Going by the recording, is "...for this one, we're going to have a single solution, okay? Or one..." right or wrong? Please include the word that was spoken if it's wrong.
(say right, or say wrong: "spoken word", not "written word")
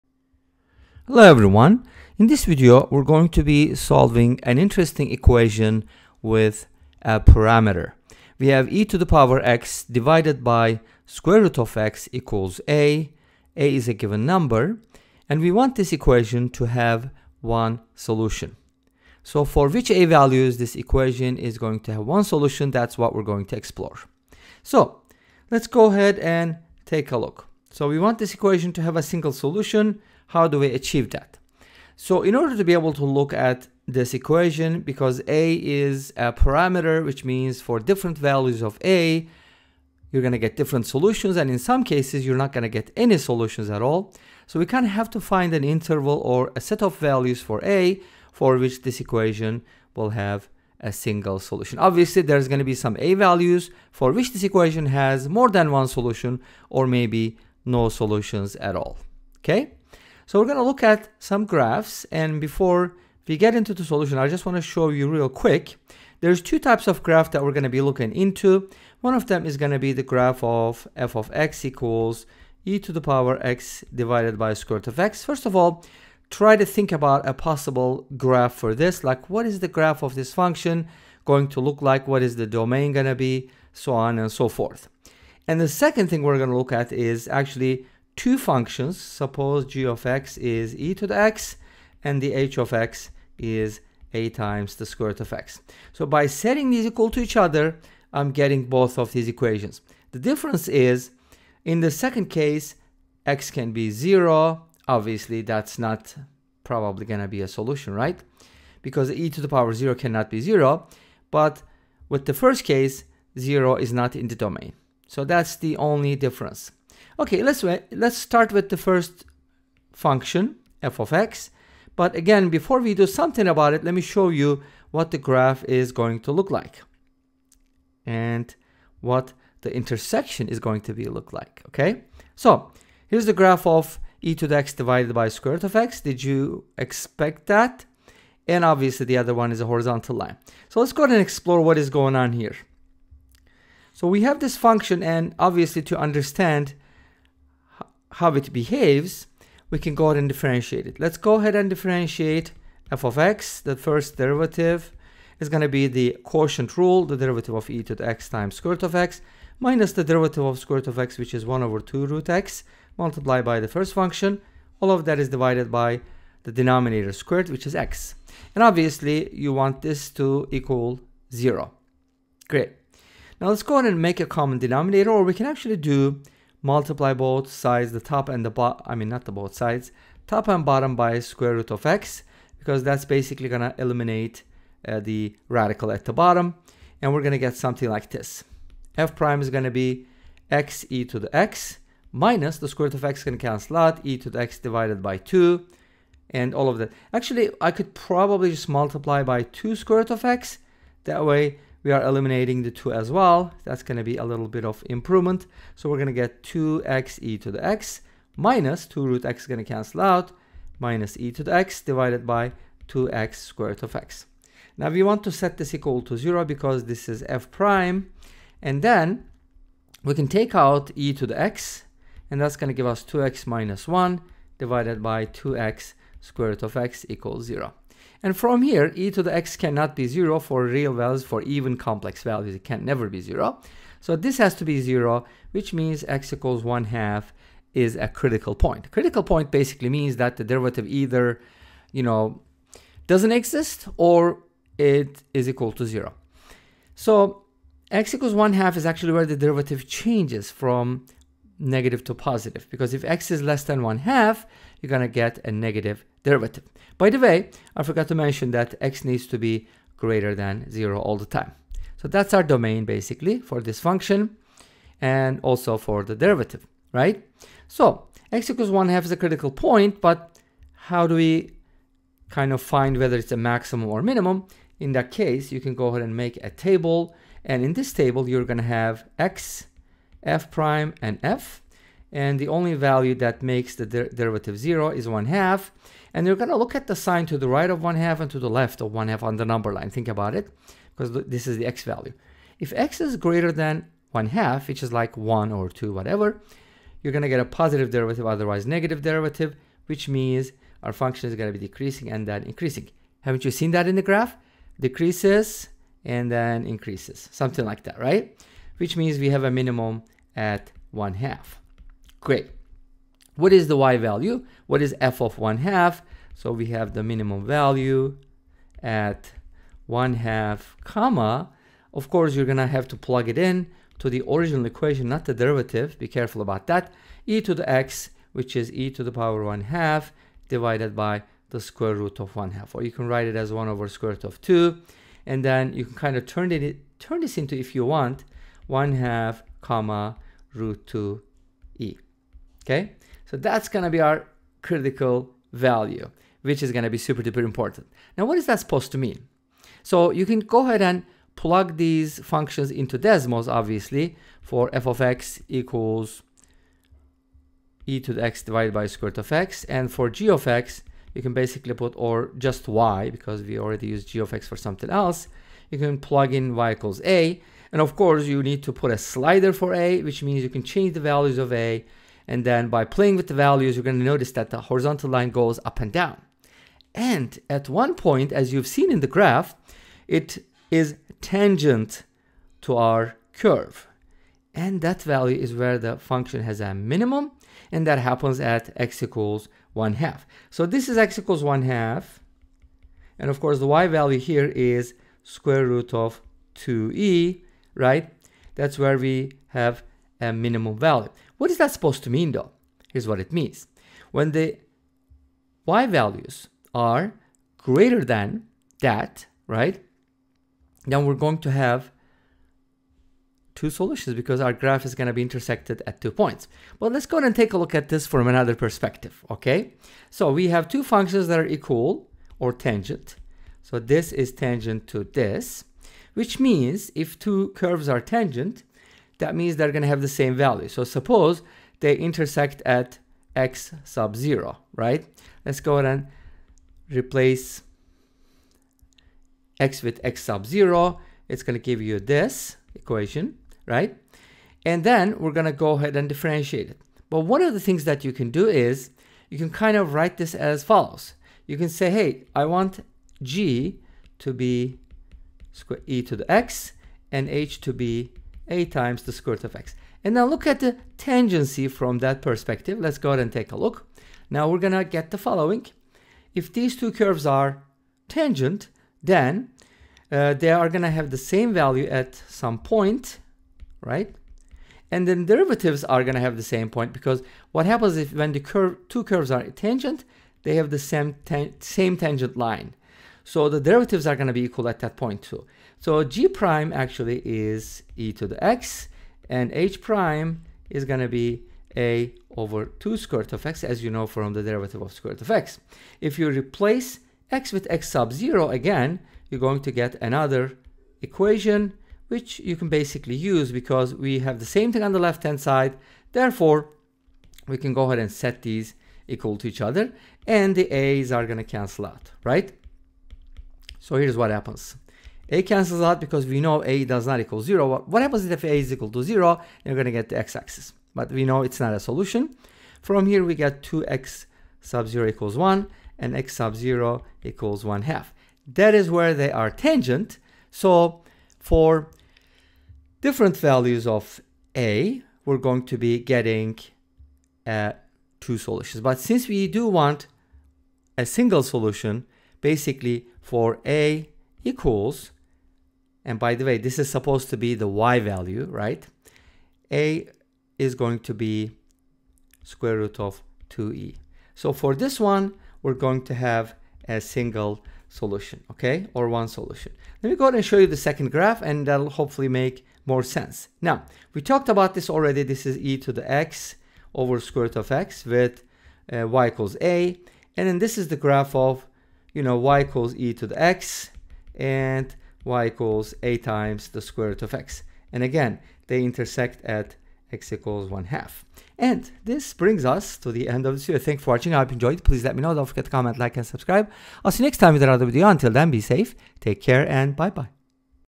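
right.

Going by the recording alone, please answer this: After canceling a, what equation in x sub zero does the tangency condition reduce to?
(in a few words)
2x0 = 1.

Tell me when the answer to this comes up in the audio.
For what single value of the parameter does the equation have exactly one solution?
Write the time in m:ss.
9:09.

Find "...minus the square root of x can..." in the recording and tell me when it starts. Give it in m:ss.
3:12.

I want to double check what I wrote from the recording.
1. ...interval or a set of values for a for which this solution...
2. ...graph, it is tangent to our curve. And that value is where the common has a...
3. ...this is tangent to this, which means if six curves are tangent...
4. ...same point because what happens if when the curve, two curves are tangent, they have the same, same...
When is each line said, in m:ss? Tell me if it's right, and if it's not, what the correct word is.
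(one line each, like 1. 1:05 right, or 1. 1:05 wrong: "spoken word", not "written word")
1. 0:45 wrong: "equation", not "solution"
2. 6:19 wrong: "function", not "common"
3. 7:03 wrong: "two", not "six"
4. 7:56 right.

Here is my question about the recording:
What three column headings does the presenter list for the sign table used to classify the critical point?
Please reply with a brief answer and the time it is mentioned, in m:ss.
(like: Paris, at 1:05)
x, f prime, and f, at 4:39.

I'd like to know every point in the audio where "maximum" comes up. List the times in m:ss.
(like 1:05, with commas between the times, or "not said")
4:33.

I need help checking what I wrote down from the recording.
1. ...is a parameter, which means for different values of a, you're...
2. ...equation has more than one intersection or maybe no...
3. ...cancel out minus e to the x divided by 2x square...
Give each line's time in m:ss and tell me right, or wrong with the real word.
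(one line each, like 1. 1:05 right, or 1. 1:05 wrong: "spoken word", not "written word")
1. 0:35 right
2. 0:54 wrong: "solution", not "intersection"
3. 3:29 right.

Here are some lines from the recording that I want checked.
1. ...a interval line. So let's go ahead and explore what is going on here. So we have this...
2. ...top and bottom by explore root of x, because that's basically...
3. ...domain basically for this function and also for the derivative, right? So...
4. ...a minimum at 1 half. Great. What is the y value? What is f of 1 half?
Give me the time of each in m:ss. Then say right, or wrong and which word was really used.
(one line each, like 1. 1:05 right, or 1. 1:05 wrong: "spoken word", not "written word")
1. 2:19 wrong: "horizontal", not "interval"
2. 3:00 wrong: "square", not "explore"
3. 4:22 right
4. 5:09 right.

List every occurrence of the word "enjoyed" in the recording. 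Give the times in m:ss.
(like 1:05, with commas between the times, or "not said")
9:44.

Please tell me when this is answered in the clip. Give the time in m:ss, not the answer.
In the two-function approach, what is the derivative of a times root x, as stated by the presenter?
8:11.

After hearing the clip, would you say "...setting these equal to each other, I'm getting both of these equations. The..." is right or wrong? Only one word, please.
right.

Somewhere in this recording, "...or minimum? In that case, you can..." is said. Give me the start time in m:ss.
4:33.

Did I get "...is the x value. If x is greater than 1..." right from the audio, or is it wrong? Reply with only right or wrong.
right.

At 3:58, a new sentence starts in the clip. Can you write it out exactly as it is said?
Critical point basically means that the derivative either, you know, doesn't exist or it is equal to 0.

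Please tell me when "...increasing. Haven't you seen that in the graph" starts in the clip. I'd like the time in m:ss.
5:02.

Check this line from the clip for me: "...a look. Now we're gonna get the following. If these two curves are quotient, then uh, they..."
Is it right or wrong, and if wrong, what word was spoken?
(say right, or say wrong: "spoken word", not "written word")
wrong: "tangent", not "quotient".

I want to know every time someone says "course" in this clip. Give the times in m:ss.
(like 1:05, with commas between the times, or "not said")
5:22, 6:07, 6:33.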